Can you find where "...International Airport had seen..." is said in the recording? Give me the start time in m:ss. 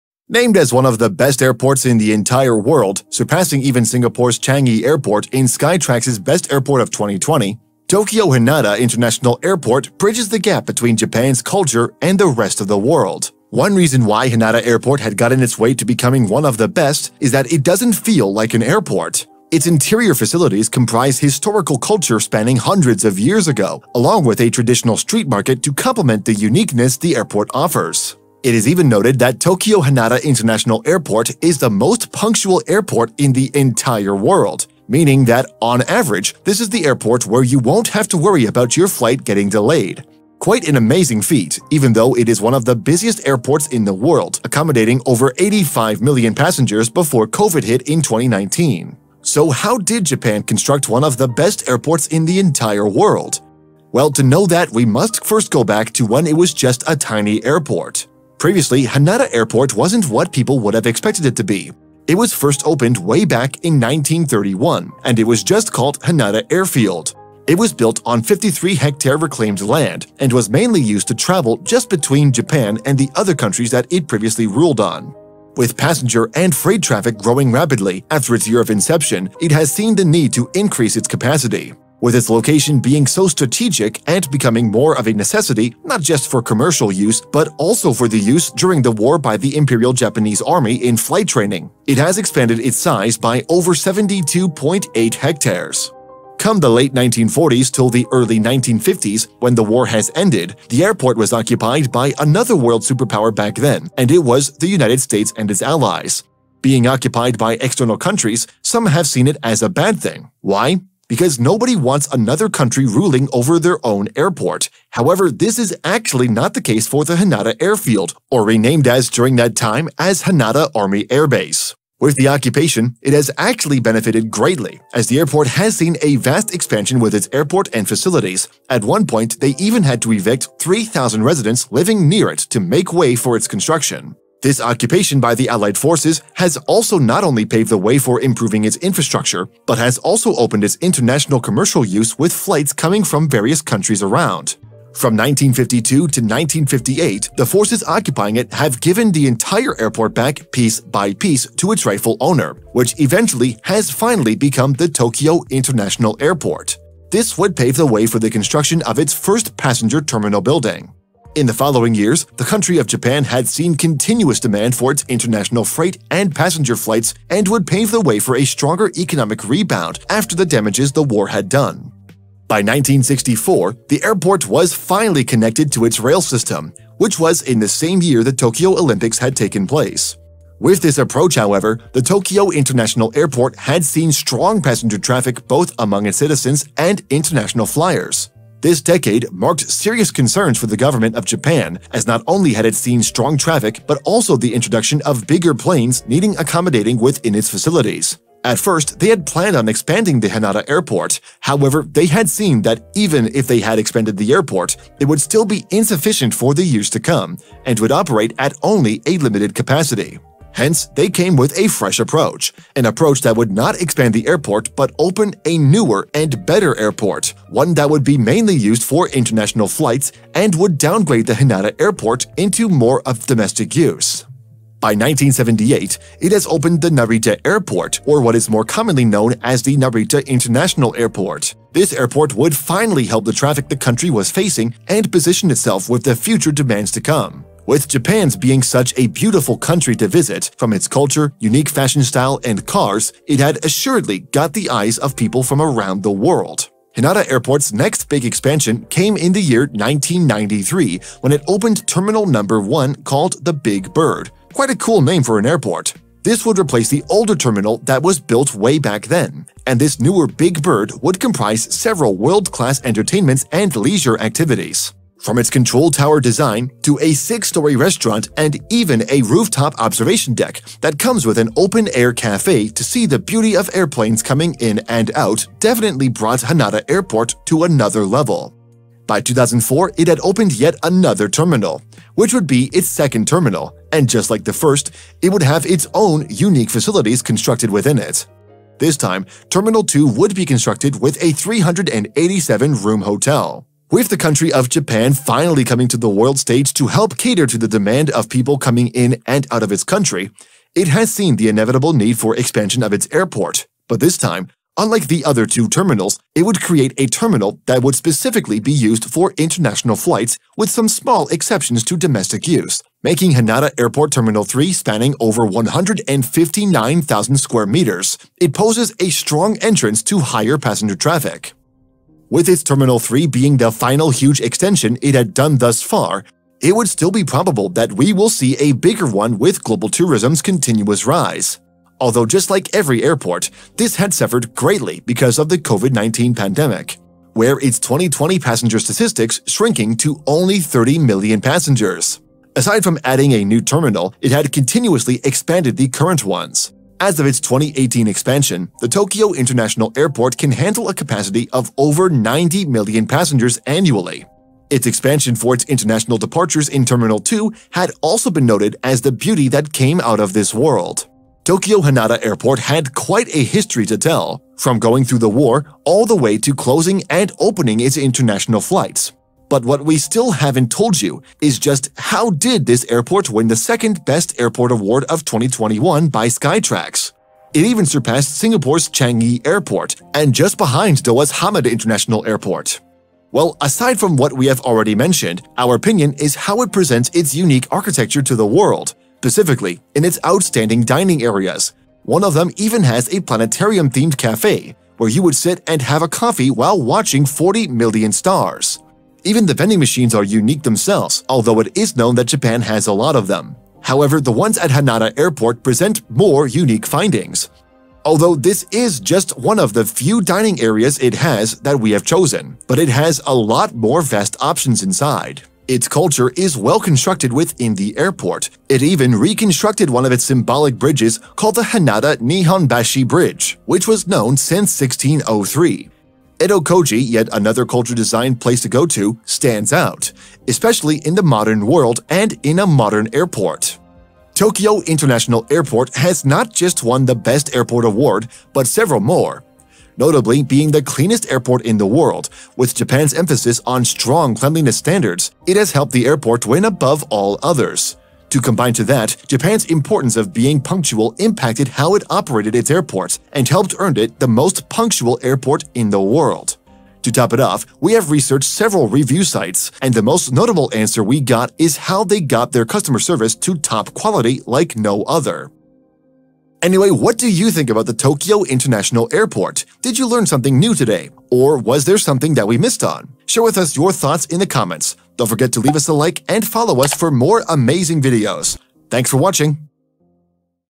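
3:02.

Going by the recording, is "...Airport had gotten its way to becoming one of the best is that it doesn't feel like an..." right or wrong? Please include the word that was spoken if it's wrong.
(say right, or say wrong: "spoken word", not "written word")
right.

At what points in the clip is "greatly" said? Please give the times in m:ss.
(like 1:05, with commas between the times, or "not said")
2:04, 5:34.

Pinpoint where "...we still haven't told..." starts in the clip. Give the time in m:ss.
6:09.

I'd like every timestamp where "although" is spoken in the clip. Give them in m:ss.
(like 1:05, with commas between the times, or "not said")
5:31, 6:41, 6:48.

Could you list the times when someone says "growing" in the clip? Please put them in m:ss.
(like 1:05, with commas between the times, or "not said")
1:17.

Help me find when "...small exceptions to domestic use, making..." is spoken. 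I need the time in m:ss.
5:10.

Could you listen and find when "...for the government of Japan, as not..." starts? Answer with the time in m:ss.
3:10.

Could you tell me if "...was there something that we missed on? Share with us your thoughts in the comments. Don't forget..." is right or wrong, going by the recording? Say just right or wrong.
right.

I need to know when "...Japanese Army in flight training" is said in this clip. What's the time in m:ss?
1:29.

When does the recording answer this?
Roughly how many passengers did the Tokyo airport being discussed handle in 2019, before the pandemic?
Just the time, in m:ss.
0:45.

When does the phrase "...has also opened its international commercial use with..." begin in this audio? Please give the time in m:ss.
2:19.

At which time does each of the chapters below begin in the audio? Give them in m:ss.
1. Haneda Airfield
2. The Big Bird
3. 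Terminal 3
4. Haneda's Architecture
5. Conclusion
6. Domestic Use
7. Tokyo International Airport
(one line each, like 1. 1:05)
1. 0:58
2. 4:10
3. 5:13
4. 6:25
5. 7:45
6. 3:30
7. 2:35.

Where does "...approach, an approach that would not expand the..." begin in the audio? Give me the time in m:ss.
3:31.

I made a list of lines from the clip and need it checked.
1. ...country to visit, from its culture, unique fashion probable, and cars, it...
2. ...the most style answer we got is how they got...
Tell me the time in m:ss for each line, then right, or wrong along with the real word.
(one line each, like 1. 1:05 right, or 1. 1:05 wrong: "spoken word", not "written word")
1. 3:59 wrong: "style", not "probable"
2. 7:39 wrong: "notable", not "style".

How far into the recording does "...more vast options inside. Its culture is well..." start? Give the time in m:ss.
6:53.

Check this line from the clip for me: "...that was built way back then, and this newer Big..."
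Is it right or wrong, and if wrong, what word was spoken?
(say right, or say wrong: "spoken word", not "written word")
right.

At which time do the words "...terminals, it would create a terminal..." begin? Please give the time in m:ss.
5:05.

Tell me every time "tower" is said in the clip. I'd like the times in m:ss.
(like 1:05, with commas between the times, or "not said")
4:25.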